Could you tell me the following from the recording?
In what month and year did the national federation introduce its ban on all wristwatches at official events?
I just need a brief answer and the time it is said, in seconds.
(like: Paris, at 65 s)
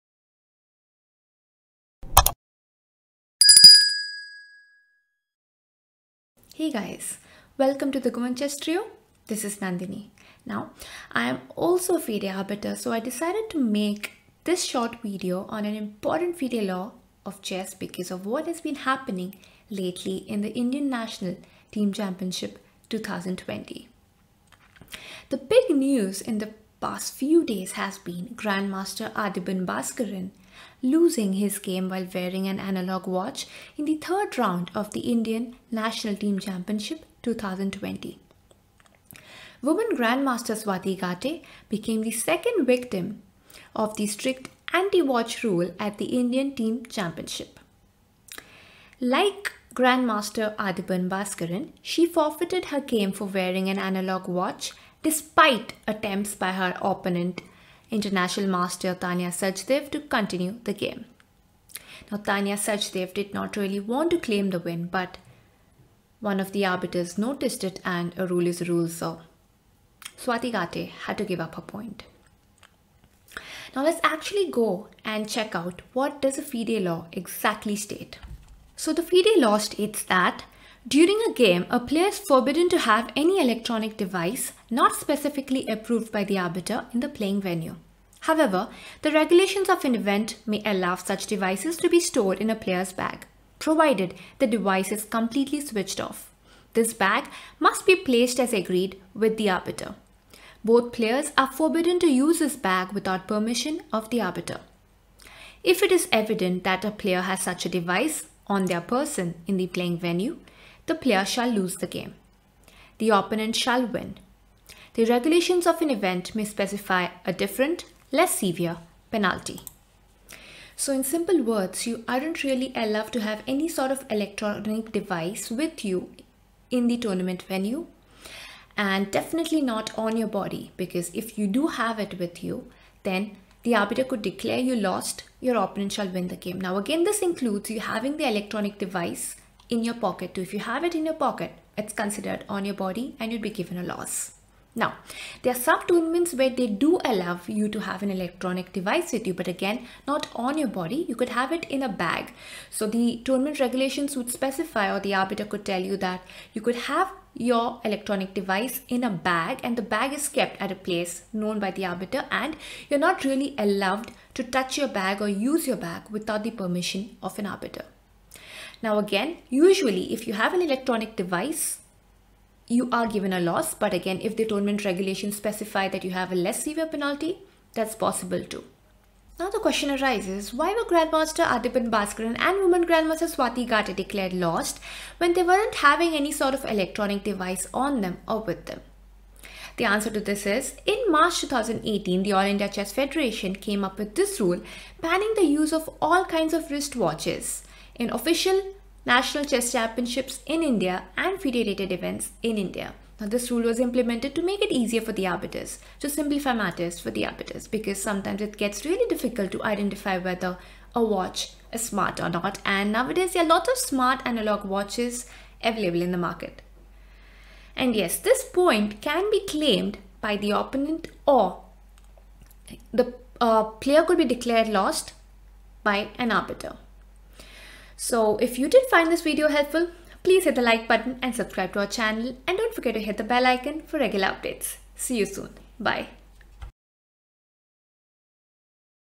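March 2018, at 191 s.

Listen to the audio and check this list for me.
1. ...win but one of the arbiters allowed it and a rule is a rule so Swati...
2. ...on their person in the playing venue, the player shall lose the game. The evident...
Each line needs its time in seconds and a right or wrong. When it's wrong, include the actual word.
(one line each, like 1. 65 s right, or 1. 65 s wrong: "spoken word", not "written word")
1. 64 s wrong: "noticed", not "allowed"
2. 108 s wrong: "opponent", not "evident".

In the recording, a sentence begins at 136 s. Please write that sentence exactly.
Now again, this includes you having the electronic device in your pocket.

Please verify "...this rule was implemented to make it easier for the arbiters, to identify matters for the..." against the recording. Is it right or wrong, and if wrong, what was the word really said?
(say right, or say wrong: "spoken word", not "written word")
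wrong: "simplify", not "identify".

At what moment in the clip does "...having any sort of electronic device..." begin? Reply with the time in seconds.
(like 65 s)
185 s.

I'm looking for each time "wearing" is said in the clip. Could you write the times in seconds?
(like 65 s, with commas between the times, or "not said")
32 s, 53 s.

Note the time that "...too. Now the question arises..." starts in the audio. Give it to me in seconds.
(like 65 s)
178 s.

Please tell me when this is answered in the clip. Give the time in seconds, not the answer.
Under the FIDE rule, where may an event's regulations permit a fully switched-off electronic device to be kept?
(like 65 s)
92 s.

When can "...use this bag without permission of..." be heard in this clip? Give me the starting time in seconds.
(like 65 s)
102 s.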